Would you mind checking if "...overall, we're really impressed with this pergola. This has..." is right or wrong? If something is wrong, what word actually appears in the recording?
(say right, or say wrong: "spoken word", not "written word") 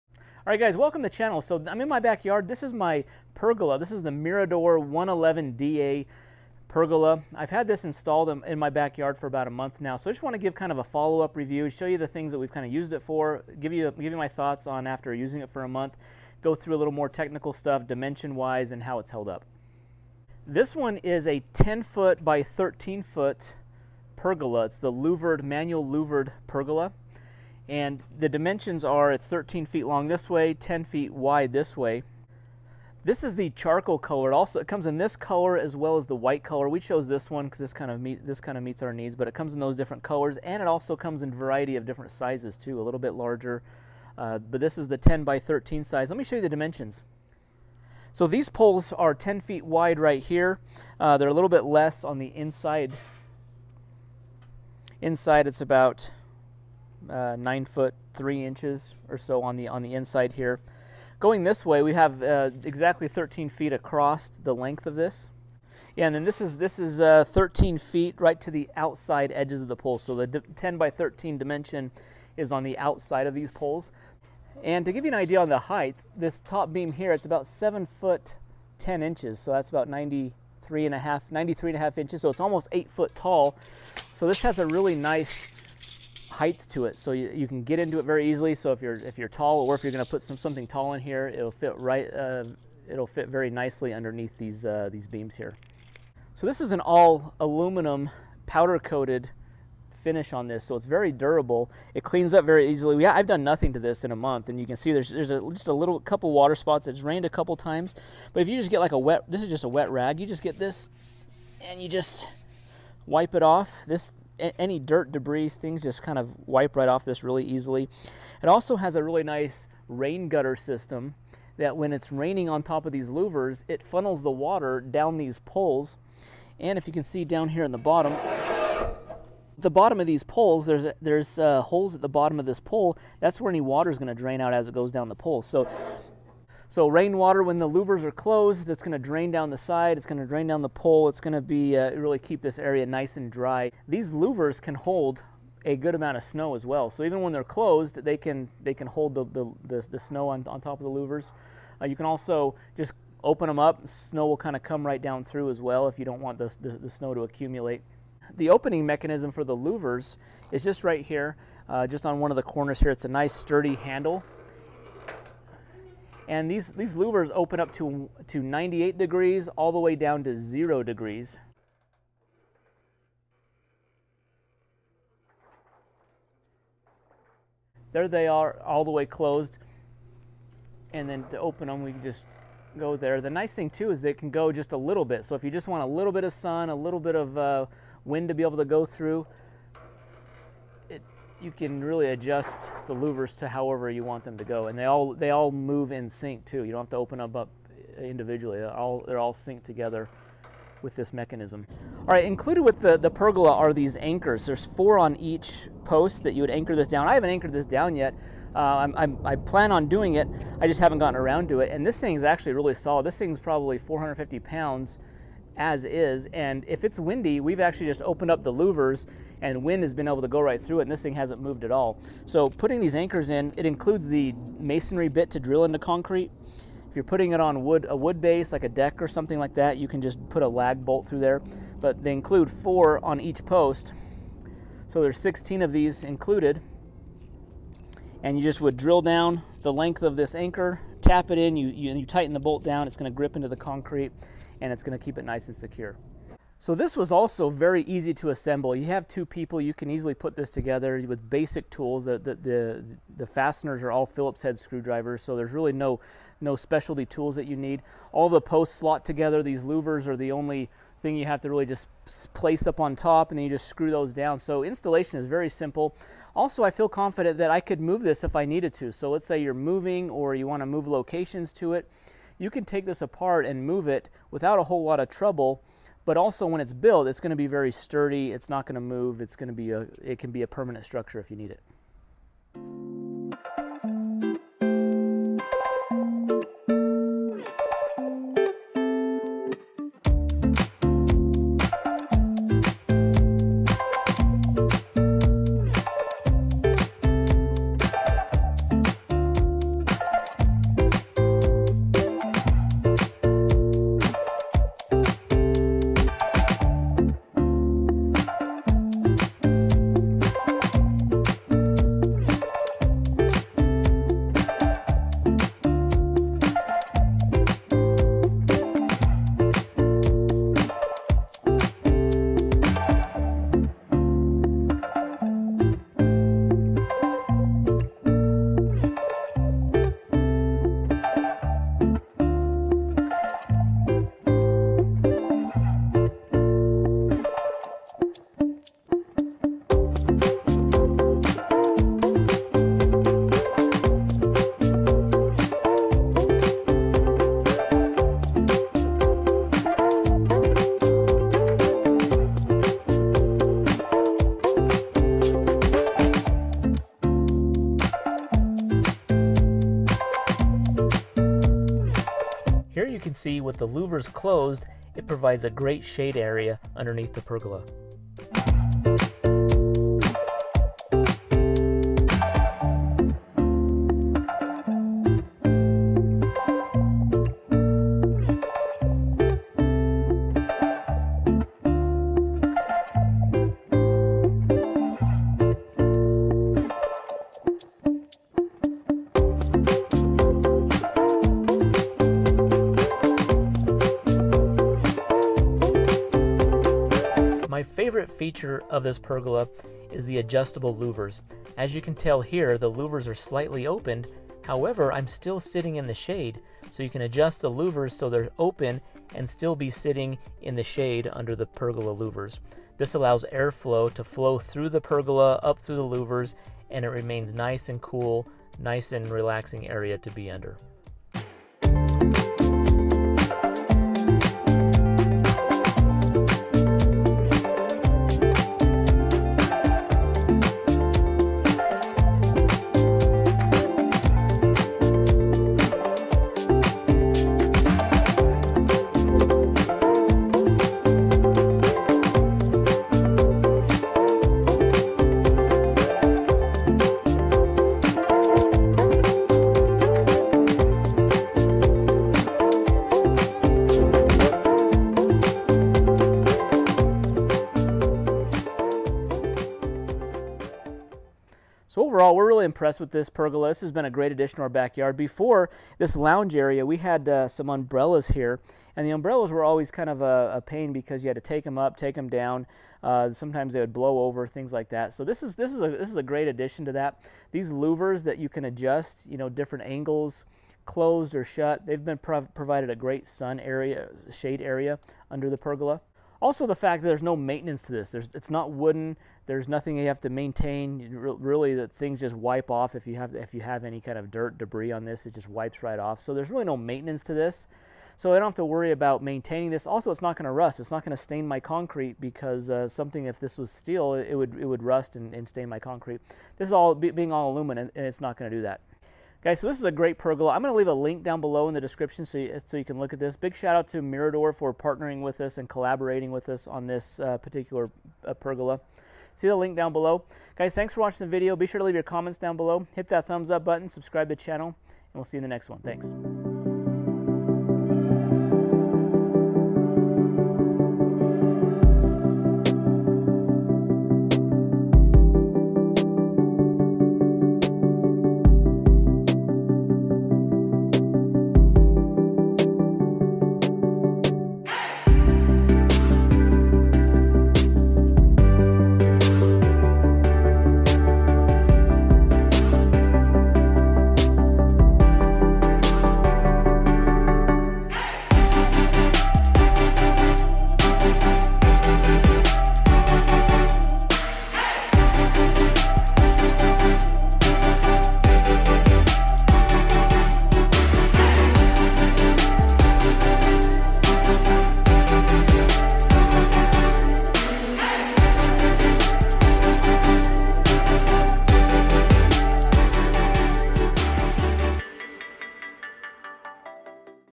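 right.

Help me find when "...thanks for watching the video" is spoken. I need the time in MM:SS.
08:40.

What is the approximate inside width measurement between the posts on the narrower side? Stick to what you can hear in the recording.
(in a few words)
9 feet 3 inches.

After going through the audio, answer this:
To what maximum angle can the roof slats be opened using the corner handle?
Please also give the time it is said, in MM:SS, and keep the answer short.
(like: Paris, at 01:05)
98 degrees, at 02:48.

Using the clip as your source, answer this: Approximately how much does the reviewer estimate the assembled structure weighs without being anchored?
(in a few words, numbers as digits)
450 pounds.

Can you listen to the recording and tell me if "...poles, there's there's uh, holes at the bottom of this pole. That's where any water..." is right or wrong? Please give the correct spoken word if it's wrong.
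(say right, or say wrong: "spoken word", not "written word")
right.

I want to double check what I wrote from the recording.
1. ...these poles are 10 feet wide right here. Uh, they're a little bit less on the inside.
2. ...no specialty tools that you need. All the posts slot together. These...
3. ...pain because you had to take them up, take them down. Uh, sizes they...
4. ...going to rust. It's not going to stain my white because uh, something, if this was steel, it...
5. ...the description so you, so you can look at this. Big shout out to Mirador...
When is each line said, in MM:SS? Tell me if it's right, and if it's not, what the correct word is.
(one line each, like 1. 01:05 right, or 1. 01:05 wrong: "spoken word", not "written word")
1. 00:48 right
2. 04:16 right
3. 07:50 wrong: "sometimes", not "sizes"
4. 08:20 wrong: "concrete", not "white"
5. 08:31 right.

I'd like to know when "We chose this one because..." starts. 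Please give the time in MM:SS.
00:36.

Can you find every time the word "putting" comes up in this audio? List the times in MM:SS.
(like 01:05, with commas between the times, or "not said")
03:42, 03:47.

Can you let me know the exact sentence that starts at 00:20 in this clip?
This one is a 10-foot by 13-foot pergola.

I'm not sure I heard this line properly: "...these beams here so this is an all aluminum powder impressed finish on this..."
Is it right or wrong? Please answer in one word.
wrong.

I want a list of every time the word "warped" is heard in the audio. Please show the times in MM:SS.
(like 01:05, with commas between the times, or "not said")
not said.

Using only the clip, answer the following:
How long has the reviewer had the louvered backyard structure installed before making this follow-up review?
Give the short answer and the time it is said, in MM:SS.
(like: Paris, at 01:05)
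about a month, at 00:09.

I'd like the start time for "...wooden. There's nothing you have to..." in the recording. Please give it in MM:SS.
08:08.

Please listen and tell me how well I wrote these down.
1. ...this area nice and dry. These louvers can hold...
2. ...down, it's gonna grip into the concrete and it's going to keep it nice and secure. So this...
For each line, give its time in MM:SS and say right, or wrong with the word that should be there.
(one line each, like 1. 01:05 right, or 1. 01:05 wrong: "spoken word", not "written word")
1. 02:22 right
2. 04:02 right.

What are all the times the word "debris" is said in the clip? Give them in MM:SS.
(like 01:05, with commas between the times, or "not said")
01:55, 08:14.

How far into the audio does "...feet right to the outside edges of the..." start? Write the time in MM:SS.
01:07.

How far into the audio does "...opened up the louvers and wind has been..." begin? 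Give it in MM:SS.
03:38.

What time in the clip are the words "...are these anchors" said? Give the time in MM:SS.
03:23.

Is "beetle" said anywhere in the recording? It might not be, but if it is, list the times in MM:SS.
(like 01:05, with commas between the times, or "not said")
not said.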